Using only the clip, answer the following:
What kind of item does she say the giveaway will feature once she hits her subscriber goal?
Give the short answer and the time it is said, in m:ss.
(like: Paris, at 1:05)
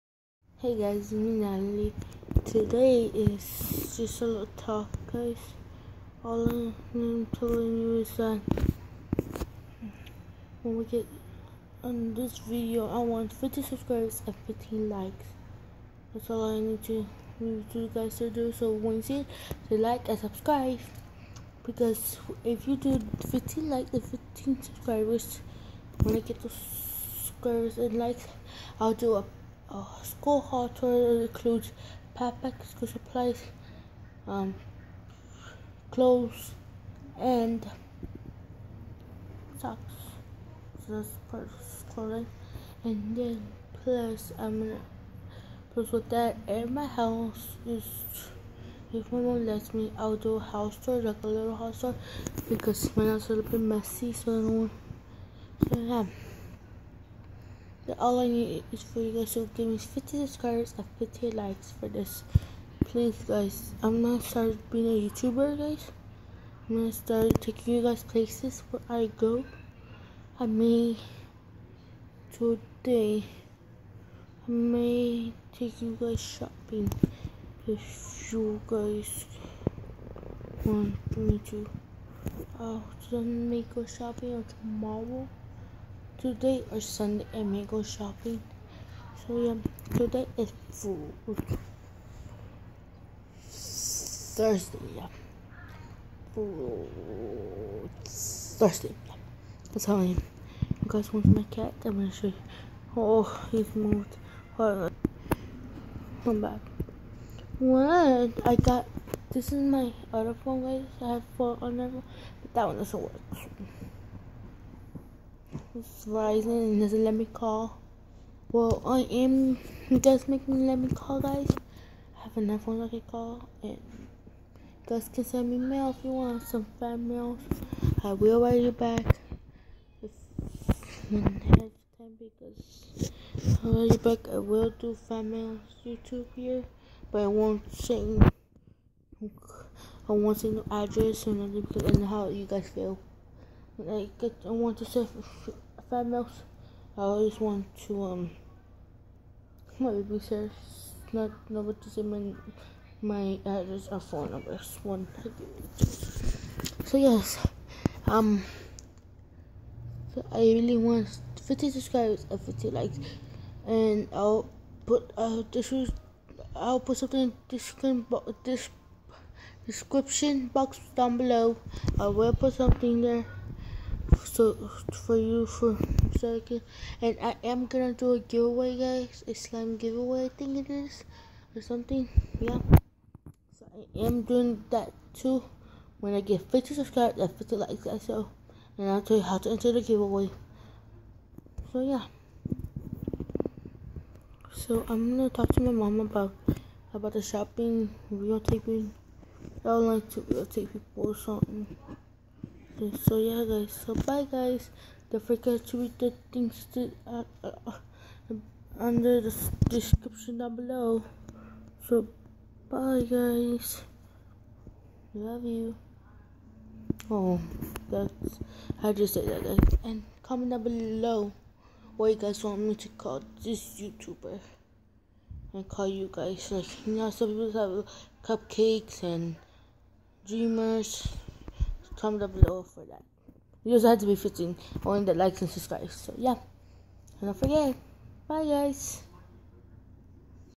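Slime, at 2:59.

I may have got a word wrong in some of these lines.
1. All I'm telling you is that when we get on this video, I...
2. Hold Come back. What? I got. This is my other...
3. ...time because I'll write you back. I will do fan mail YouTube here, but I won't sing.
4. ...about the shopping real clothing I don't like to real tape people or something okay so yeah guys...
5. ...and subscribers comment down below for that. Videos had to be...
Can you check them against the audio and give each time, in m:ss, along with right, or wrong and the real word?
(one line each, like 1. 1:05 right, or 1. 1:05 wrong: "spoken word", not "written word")
1. 0:06 right
2. 1:44 right
3. 2:11 right
4. 3:16 wrong: "taping", not "clothing"
5. 3:49 wrong: "dreamers", not "subscribers".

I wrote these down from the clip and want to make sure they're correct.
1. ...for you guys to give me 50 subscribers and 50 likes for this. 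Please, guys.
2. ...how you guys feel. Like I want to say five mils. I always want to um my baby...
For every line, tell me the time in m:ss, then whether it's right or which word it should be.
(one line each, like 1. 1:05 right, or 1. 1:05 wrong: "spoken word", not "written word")
1. 0:58 right
2. 2:22 right.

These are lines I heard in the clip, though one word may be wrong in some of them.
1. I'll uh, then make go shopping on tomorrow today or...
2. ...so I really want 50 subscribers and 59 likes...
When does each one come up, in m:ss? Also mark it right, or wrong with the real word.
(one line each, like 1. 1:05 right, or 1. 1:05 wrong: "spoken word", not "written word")
1. 1:22 right
2. 2:40 wrong: "50", not "59".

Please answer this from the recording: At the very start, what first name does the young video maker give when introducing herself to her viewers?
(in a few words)
Natalie.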